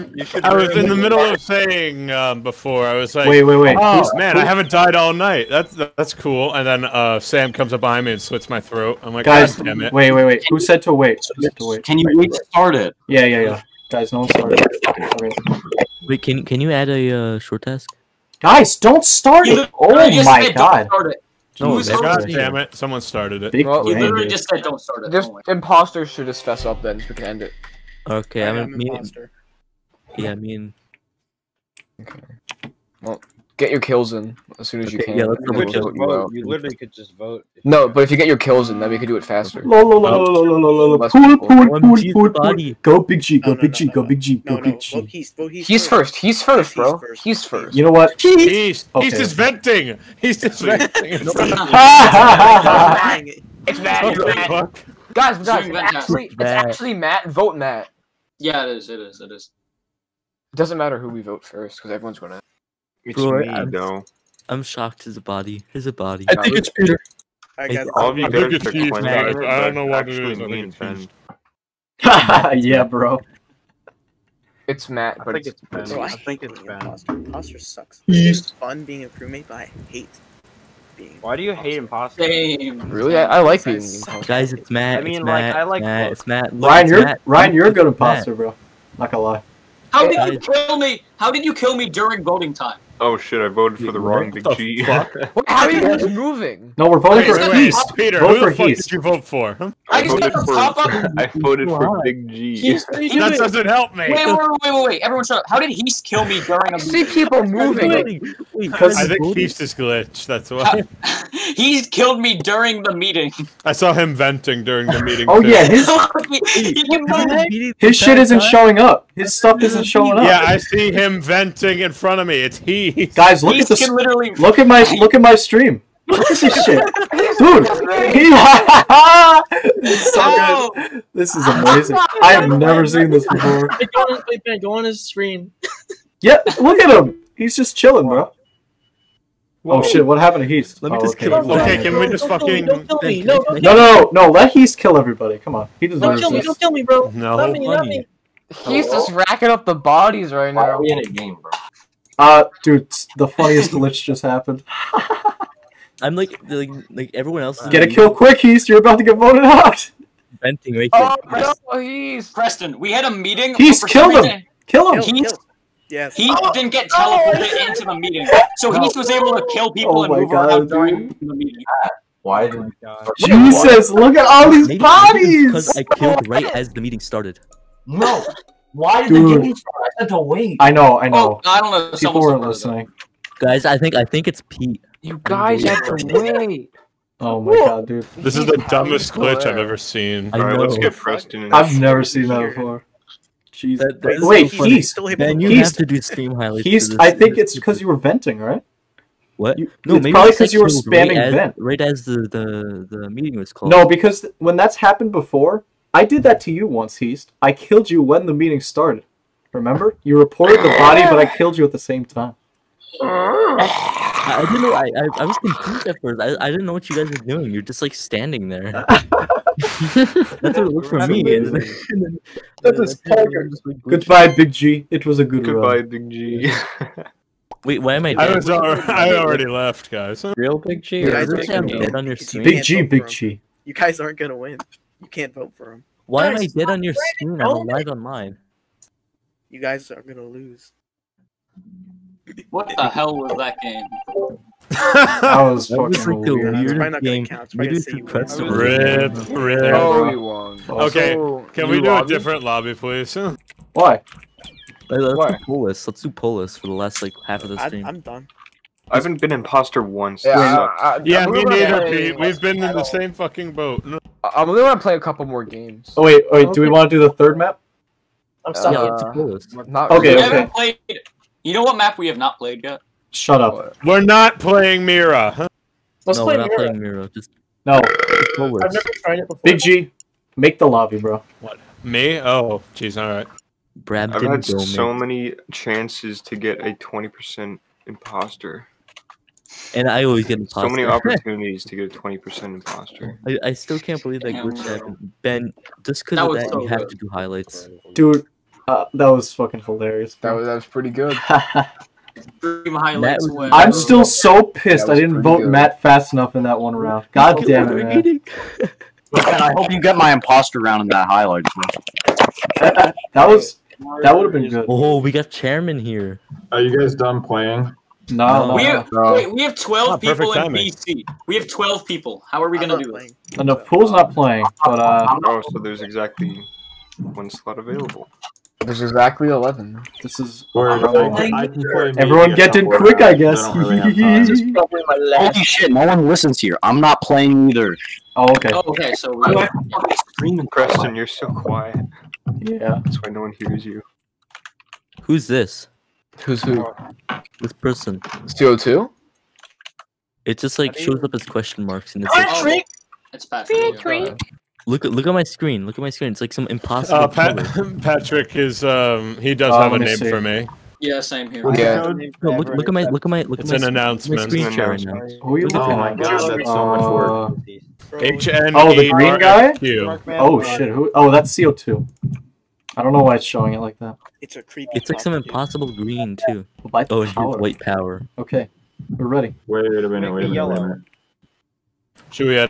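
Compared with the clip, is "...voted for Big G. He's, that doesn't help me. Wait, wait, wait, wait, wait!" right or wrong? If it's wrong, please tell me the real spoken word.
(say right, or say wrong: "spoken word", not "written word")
right.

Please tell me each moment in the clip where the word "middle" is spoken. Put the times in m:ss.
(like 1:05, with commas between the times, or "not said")
0:00.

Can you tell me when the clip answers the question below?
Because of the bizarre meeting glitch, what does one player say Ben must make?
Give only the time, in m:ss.
3:16.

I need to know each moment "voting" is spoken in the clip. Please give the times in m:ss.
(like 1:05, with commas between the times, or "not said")
1:32, 1:36.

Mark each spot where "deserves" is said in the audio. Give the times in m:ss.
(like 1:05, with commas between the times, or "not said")
2:25.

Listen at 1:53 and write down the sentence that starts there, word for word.
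I saw him venting during the meeting.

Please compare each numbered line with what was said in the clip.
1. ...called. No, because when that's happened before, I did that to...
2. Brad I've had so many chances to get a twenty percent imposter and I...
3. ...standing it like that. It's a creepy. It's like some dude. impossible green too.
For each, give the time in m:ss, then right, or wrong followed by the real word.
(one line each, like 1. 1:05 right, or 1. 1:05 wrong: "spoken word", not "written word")
1. 3:23 right
2. 4:43 right
3. 6:13 wrong: "showing", not "standing".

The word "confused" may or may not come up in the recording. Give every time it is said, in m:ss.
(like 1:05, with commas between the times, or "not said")
3:35.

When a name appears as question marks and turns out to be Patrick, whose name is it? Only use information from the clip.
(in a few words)
CO2.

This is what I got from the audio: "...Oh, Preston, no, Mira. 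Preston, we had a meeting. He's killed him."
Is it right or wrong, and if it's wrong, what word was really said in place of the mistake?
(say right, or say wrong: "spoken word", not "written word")
wrong: "Heath", not "Mira".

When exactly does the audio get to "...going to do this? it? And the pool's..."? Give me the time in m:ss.
5:22.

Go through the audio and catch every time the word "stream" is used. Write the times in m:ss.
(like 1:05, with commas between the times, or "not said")
2:05, 2:15, 4:17.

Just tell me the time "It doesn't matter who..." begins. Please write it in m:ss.
1:00.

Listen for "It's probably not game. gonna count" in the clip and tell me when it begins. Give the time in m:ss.
4:06.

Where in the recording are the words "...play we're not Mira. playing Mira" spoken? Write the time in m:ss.
4:36.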